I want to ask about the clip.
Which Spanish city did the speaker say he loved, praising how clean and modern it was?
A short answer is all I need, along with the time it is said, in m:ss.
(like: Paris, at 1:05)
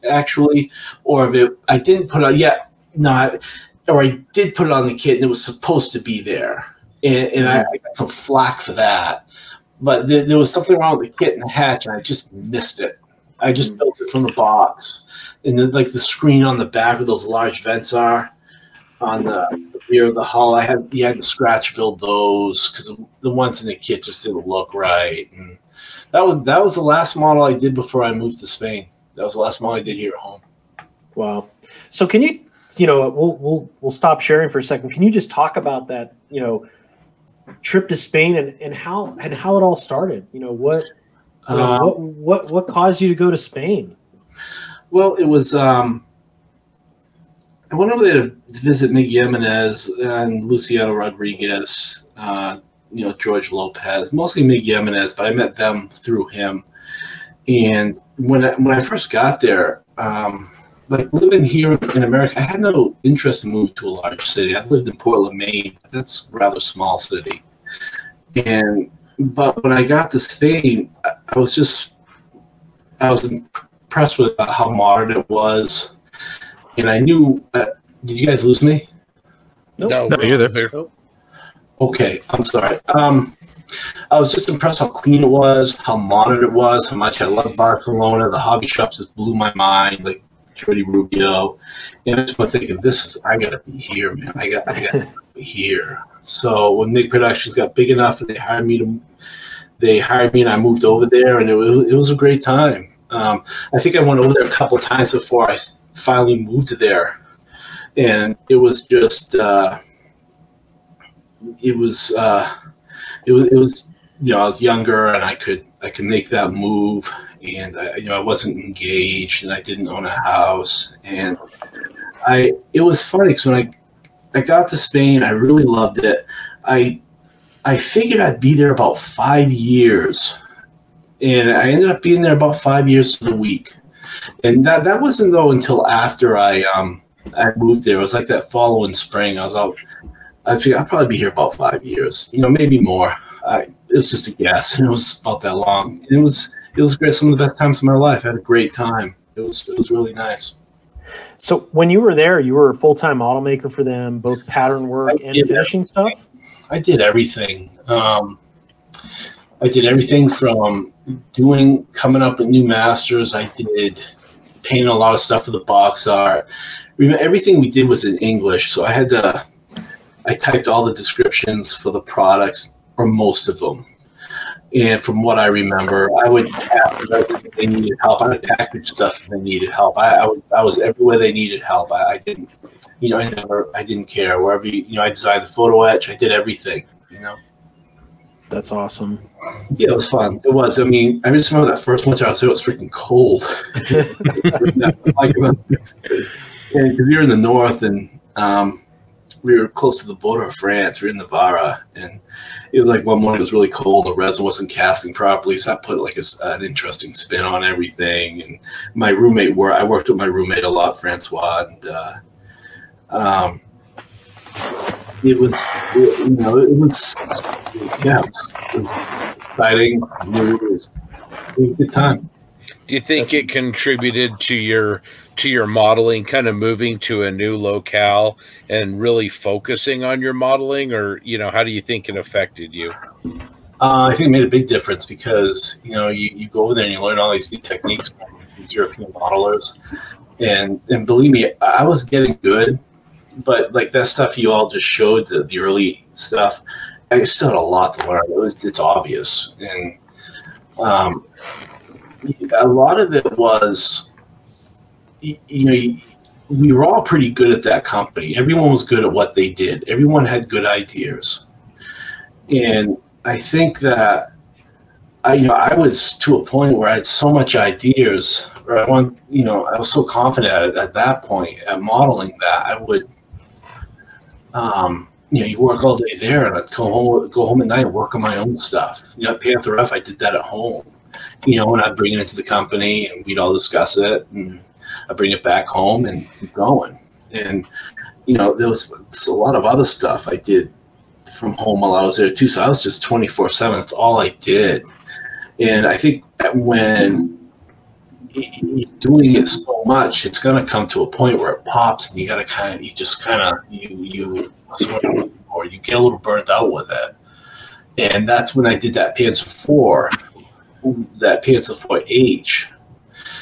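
Barcelona, at 1:27.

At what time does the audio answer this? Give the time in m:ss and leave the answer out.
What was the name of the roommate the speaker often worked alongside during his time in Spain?
3:30.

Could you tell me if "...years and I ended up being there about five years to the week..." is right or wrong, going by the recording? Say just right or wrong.
right.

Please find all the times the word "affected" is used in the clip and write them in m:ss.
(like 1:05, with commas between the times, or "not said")
3:52.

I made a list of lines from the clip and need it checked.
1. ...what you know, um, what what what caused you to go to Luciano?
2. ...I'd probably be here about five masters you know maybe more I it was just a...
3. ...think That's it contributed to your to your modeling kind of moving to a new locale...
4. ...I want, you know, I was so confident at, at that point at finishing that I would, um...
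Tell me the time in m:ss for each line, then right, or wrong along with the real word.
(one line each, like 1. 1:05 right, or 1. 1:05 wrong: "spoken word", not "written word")
1. 0:40 wrong: "Spain", not "Luciano"
2. 2:20 wrong: "years", not "masters"
3. 3:43 right
4. 4:28 wrong: "modeling", not "finishing".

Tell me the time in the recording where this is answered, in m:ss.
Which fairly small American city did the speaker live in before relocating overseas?
1:04.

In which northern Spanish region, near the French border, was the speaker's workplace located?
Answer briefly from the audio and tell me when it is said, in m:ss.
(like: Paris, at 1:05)
Navarra, at 3:21.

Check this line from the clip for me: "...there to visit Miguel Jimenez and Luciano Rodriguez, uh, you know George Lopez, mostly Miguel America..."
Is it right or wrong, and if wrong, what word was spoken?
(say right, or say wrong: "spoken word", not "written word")
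wrong: "Jimenez", not "America".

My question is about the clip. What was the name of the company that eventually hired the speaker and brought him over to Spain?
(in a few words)
MiG Productions.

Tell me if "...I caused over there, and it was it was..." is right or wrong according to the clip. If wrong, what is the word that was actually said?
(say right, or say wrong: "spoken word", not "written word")
wrong: "moved", not "caused".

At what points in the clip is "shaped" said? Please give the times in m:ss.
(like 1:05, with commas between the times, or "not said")
not said.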